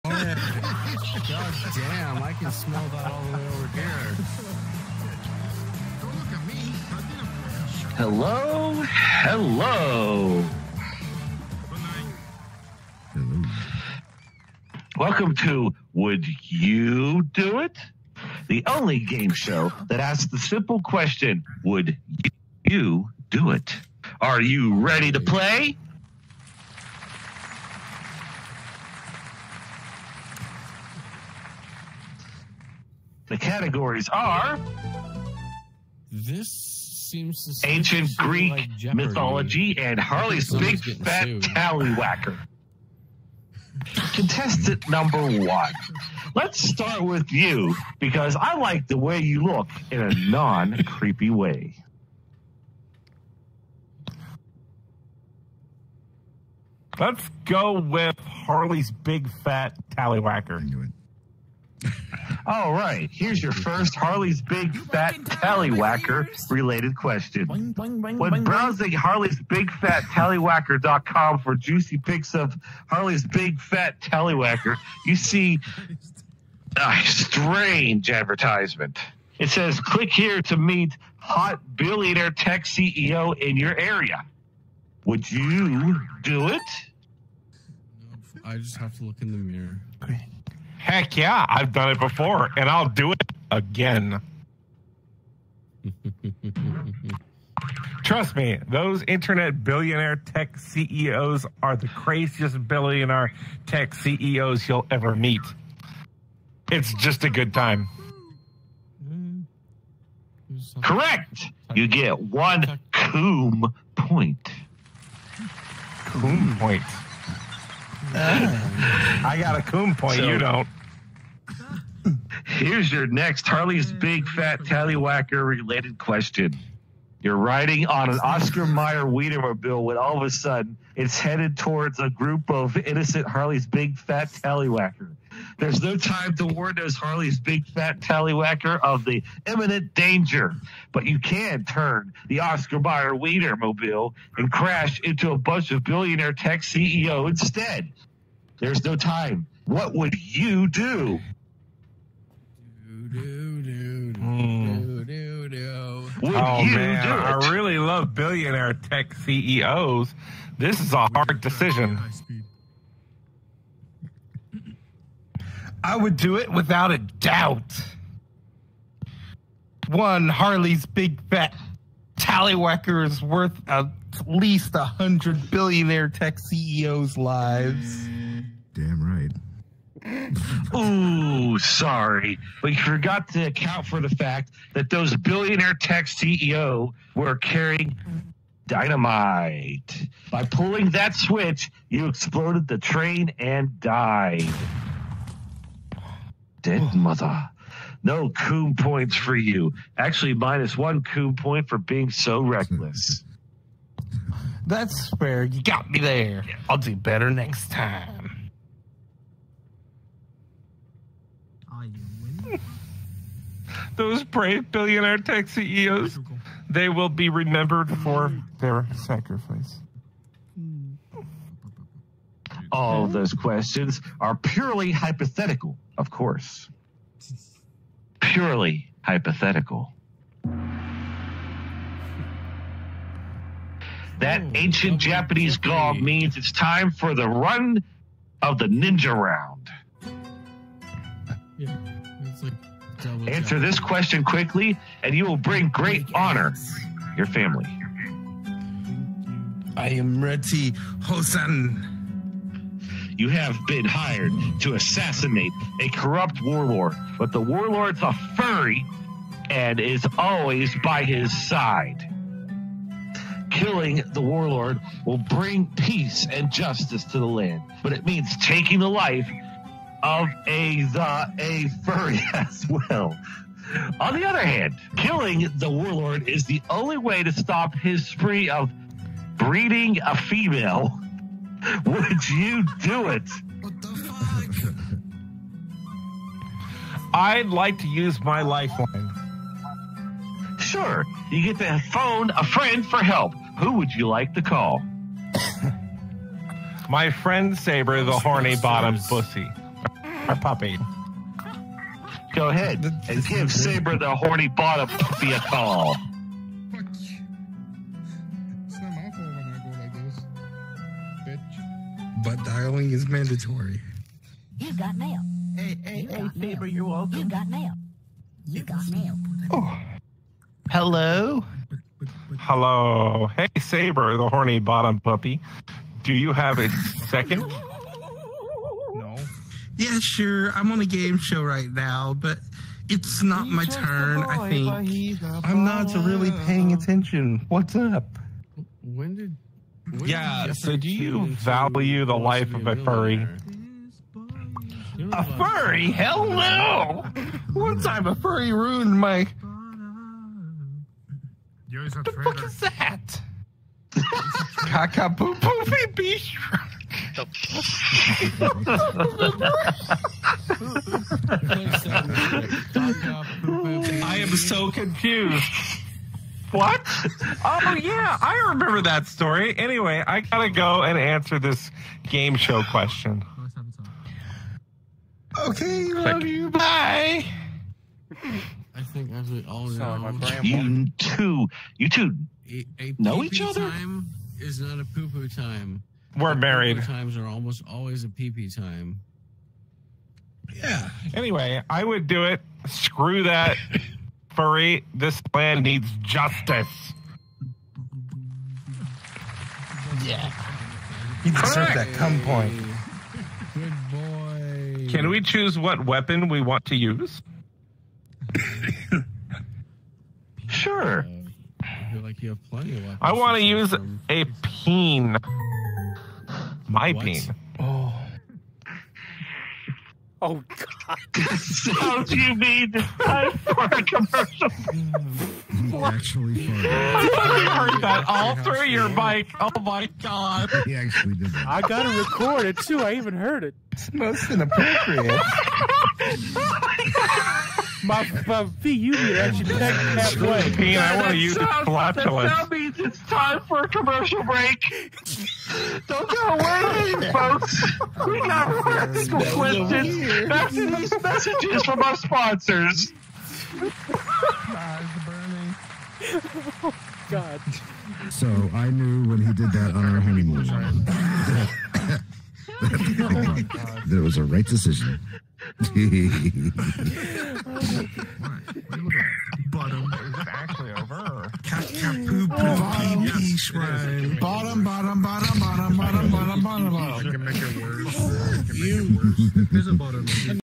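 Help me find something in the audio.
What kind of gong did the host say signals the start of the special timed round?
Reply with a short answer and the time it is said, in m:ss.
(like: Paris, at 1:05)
Ancient Japanese gong, at 3:54.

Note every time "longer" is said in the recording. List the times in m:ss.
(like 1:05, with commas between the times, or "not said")
not said.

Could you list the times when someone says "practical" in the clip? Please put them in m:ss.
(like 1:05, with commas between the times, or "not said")
7:28.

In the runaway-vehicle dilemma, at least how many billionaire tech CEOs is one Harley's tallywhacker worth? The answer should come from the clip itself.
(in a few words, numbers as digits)
100.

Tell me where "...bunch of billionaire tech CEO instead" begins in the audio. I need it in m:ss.
2:25.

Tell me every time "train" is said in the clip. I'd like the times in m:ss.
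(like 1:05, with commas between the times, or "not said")
3:12.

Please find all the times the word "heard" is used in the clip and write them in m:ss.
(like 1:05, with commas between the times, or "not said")
7:07, 7:13.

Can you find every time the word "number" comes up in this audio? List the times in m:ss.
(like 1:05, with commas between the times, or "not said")
0:44.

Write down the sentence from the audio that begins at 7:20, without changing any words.
Pete, I want to use the flatulence.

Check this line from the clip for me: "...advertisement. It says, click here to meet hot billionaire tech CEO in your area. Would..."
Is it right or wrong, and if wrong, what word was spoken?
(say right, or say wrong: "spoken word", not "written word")
right.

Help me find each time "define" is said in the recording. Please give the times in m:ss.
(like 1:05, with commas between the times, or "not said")
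not said.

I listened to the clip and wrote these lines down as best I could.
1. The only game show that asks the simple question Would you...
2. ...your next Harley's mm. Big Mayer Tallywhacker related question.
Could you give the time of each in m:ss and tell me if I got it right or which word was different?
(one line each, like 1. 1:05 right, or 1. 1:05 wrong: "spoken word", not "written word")
1. 0:18 right
2. 2:02 wrong: "Fat", not "Mayer".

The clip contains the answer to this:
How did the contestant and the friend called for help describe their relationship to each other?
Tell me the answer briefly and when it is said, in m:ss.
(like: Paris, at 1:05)
Married, at 6:26.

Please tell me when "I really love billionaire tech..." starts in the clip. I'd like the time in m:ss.
2:37.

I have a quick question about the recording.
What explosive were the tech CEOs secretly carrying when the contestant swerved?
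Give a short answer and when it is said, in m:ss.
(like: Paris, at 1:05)
Dynamite, at 3:08.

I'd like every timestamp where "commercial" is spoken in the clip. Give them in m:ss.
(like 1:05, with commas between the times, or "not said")
7:03, 7:23.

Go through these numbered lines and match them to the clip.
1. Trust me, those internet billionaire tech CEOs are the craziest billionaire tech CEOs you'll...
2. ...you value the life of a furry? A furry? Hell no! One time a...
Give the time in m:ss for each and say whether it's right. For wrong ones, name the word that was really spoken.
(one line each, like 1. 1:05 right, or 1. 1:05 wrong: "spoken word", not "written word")
1. 1:38 right
2. 5:40 right.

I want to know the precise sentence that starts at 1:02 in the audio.
All right, here's your first Harley's Big Fat Tallywhacker related question.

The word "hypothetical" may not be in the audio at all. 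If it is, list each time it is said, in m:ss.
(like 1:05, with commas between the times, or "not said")
3:44, 3:49.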